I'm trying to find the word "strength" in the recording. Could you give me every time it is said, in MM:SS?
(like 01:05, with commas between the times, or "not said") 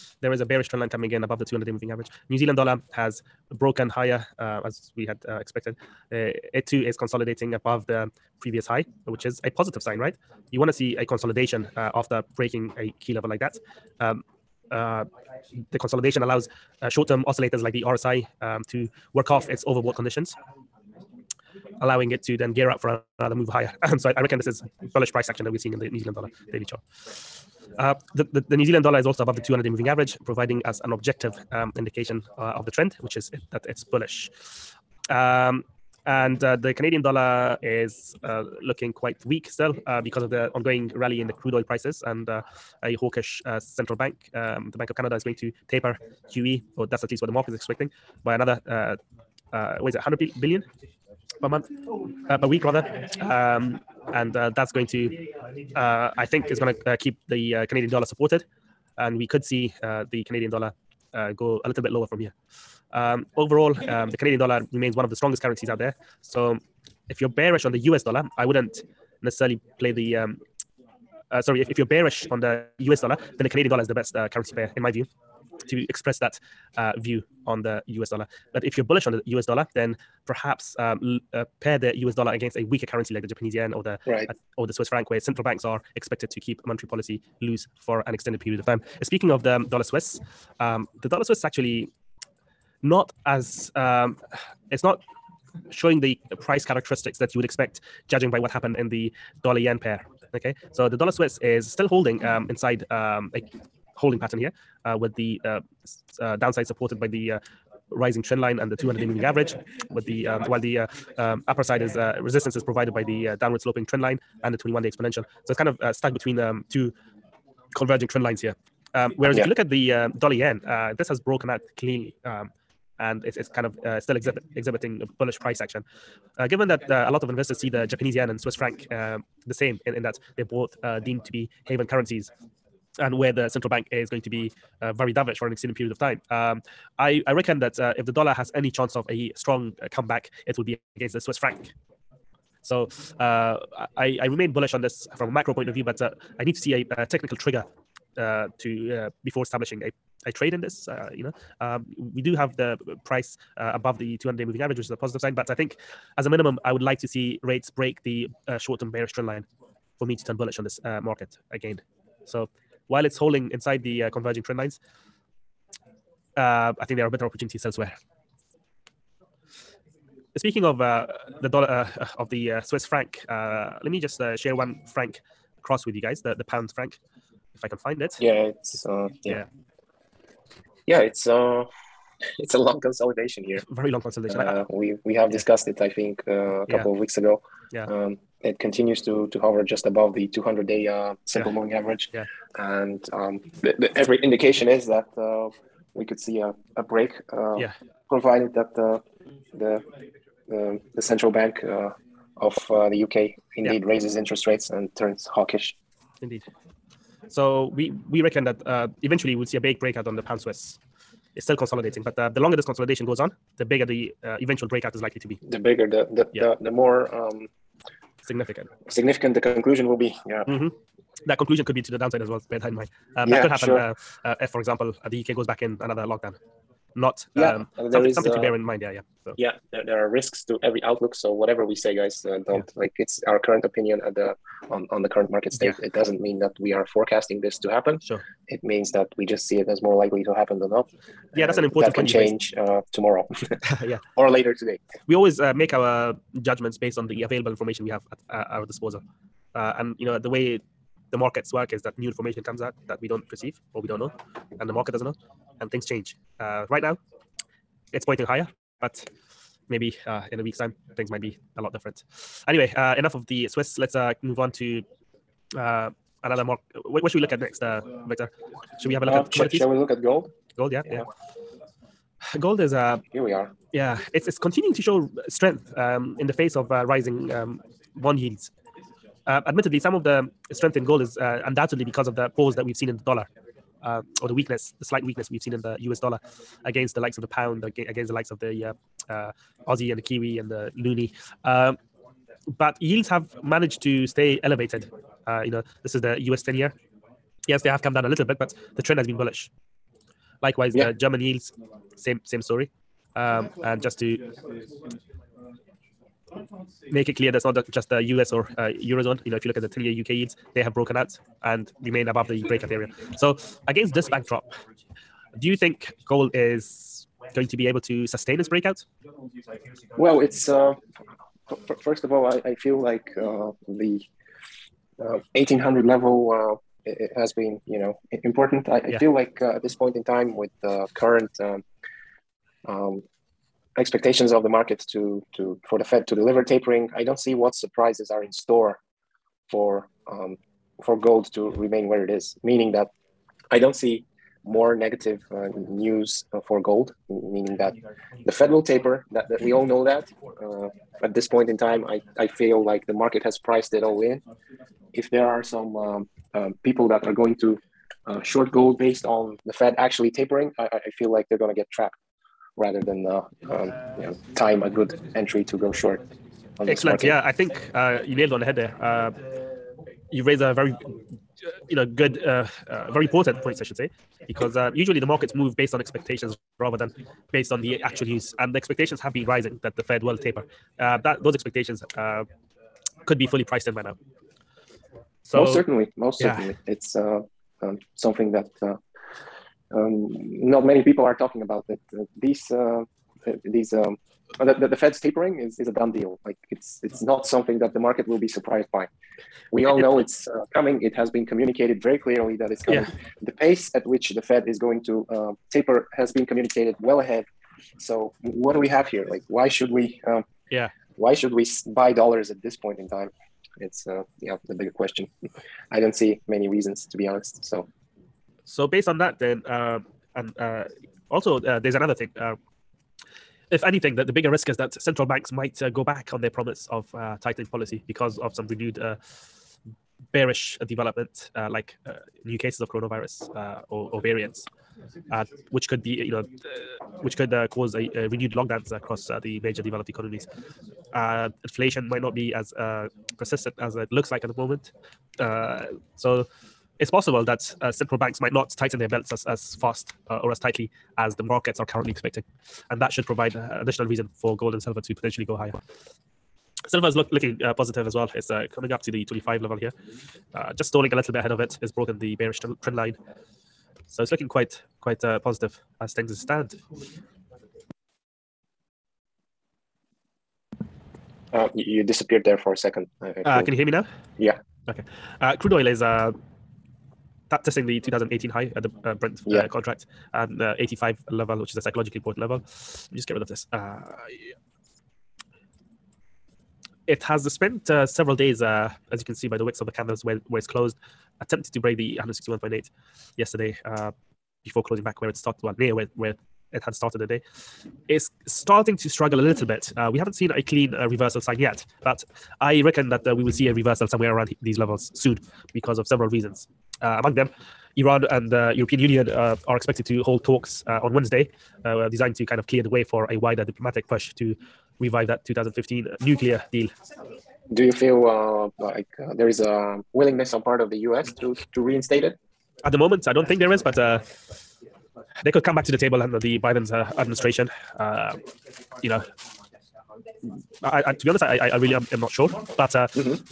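04:35, 04:40.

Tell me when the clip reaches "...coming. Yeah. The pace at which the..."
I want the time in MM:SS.
06:42.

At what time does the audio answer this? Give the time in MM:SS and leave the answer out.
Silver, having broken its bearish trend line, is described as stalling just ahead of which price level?
07:39.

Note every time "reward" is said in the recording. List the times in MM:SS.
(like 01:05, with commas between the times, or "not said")
not said.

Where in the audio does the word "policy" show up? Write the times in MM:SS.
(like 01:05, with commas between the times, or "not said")
01:26, 07:07.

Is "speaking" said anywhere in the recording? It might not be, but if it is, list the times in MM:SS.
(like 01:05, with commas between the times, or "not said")
01:29, 02:50.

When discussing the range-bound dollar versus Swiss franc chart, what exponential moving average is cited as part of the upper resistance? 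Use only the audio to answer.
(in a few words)
21-day exponential.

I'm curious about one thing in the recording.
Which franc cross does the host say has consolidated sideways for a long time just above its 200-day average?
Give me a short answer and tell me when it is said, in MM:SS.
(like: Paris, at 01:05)
Pound franc, at 02:56.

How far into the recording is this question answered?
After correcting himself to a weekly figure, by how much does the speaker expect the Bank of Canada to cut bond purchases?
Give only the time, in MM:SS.
00:49.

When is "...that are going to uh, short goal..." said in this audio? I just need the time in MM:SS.
05:56.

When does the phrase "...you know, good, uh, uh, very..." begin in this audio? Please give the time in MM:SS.
06:11.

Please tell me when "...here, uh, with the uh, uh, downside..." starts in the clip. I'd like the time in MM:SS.
01:44.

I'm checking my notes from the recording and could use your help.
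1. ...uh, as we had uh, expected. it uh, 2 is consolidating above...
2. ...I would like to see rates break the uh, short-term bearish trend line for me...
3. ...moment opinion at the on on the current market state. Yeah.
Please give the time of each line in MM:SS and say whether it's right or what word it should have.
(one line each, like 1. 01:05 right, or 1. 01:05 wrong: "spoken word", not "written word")
1. 00:04 right
2. 02:36 right
3. 03:53 wrong: "current", not "moment".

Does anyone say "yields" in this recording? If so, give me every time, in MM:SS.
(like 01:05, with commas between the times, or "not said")
04:38, 04:52, 05:01, 05:10.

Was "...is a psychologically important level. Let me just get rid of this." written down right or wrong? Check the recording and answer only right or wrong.
right.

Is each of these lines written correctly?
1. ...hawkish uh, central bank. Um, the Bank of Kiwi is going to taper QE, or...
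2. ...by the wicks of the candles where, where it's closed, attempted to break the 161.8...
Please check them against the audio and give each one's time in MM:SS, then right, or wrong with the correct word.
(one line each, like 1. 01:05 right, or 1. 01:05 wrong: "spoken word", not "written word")
1. 00:42 wrong: "Canada", not "Kiwi"
2. 08:09 right.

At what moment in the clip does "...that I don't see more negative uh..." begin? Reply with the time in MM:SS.
05:42.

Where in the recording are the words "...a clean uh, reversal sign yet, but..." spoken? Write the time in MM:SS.
08:20.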